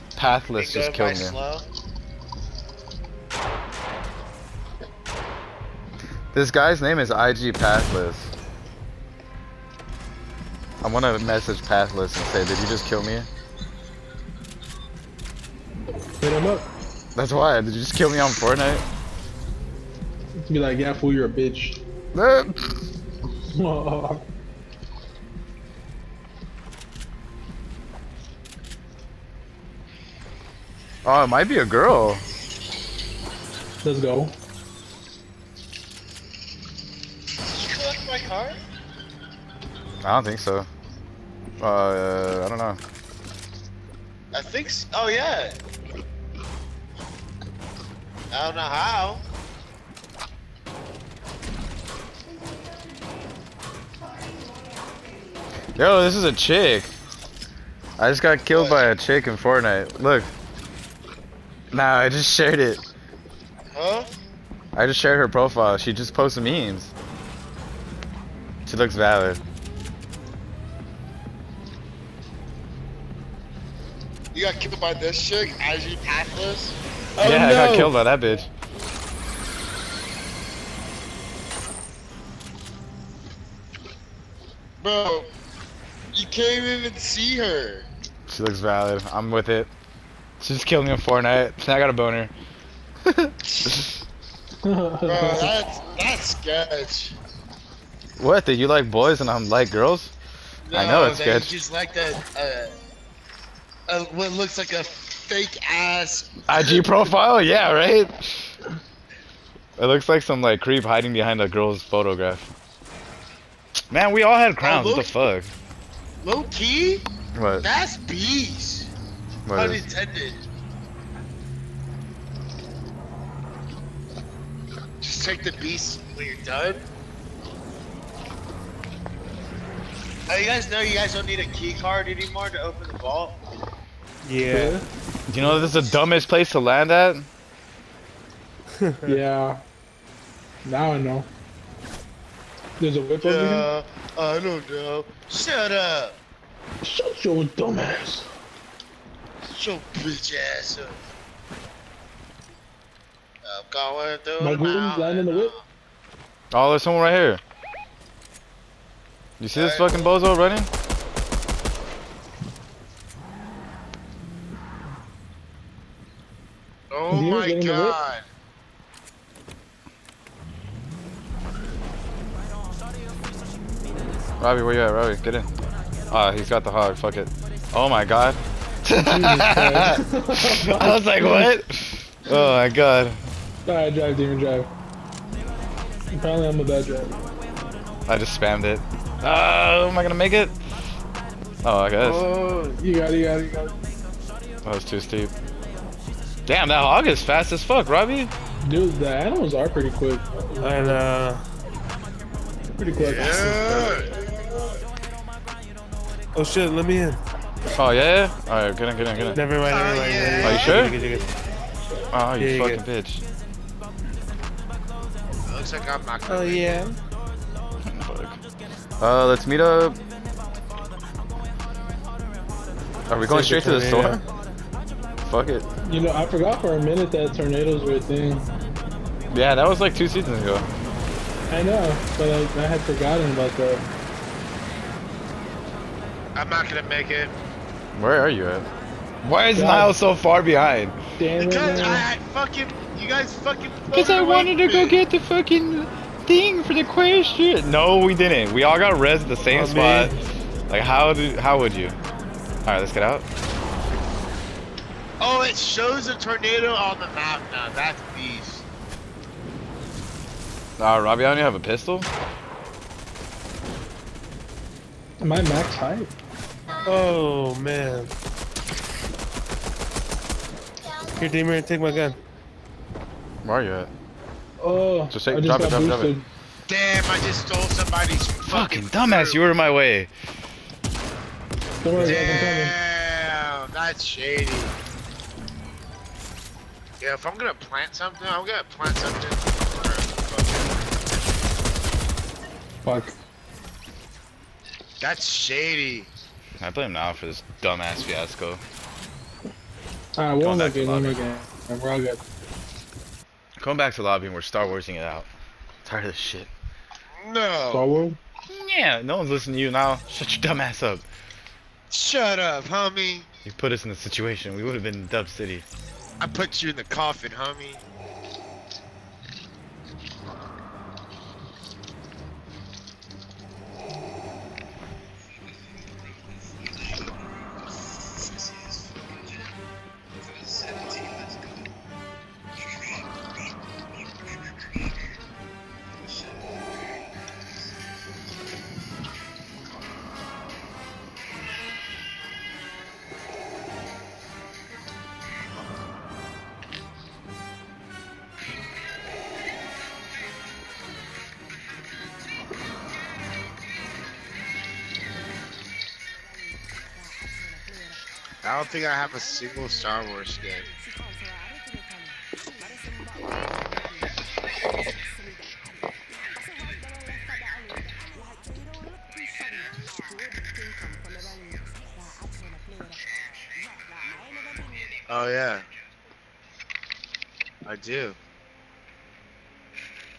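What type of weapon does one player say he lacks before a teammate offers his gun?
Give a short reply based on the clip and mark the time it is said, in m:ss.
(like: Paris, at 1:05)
Pistol, at 4:21.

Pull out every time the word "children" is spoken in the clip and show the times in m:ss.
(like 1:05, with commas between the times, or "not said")
not said.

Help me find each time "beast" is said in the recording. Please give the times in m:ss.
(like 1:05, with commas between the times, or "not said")
2:05, 4:18.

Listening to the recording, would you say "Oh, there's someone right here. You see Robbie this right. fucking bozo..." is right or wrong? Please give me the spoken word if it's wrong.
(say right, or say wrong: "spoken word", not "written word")
wrong: "All", not "Robbie".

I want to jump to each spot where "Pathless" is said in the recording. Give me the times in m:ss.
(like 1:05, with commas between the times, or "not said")
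0:00, 0:07, 0:11.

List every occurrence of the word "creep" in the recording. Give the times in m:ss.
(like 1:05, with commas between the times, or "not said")
1:50.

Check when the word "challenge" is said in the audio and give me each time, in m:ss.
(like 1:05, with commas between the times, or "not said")
not said.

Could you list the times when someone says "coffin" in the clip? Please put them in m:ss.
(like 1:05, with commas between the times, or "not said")
5:16.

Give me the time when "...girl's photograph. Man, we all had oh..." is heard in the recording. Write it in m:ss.
1:51.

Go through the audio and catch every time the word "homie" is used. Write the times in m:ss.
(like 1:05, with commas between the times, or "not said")
5:12, 5:17.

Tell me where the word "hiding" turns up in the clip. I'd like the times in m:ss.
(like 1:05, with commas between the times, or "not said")
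1:50.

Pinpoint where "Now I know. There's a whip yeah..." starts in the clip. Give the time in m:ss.
2:20.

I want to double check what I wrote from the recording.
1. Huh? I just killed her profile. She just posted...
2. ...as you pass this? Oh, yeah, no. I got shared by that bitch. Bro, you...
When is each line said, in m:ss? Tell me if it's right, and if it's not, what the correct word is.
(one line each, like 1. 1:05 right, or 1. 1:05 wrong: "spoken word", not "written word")
1. 1:03 wrong: "shared", not "killed"
2. 1:15 wrong: "killed", not "shared".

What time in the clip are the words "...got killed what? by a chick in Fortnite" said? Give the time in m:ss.
0:58.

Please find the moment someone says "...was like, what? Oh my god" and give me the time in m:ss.
3:00.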